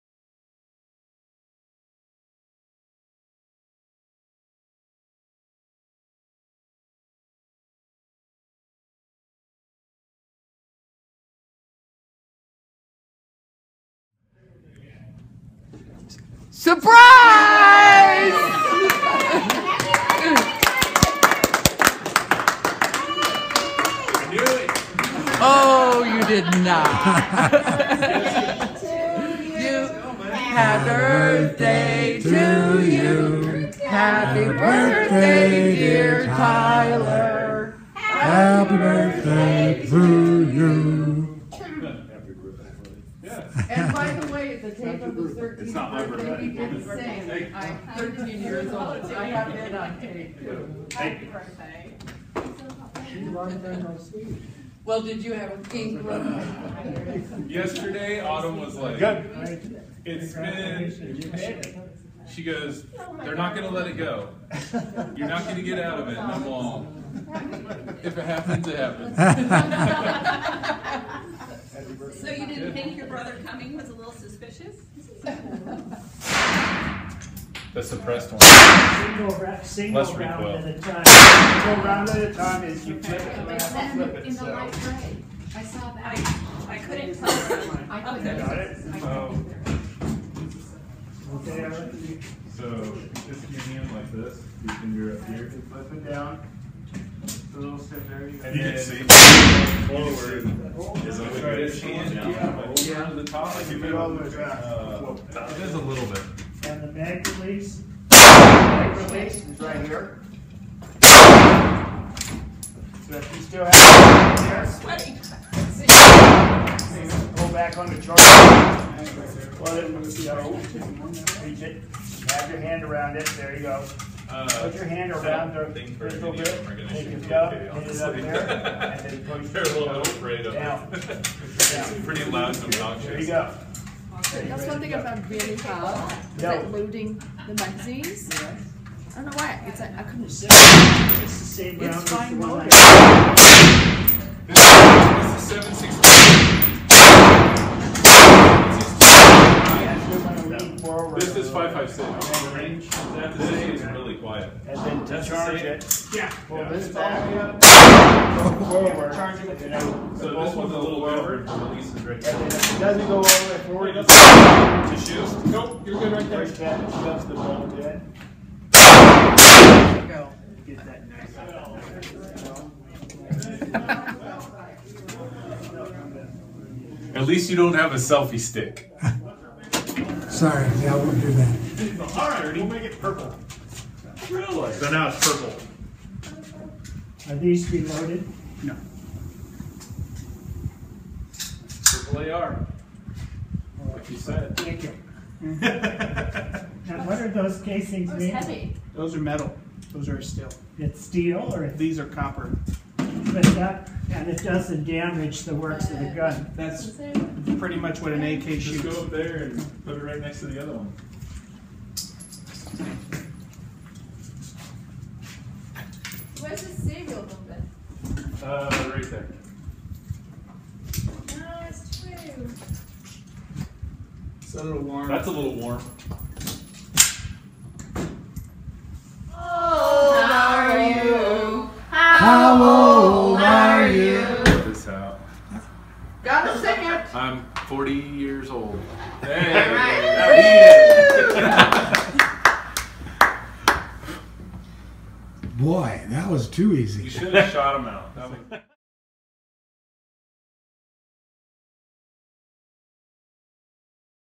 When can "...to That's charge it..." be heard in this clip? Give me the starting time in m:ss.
2:35.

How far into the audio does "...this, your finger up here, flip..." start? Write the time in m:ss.
1:34.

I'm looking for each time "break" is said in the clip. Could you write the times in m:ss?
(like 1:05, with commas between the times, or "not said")
2:46.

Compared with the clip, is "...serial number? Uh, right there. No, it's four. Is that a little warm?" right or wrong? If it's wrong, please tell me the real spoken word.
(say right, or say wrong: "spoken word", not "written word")
wrong: "two", not "four".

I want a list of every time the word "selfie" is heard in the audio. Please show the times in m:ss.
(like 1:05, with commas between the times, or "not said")
2:57.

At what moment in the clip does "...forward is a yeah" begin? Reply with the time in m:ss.
1:39.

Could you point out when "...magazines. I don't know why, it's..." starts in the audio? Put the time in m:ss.
2:17.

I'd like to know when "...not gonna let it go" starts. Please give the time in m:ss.
1:03.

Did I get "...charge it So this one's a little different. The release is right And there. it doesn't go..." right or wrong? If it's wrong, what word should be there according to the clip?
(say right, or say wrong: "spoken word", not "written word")
right.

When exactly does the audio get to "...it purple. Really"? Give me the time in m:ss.
3:02.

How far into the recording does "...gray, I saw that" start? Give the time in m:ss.
1:24.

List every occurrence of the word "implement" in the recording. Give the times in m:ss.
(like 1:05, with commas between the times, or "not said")
not said.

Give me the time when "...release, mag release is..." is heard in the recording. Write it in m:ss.
1:47.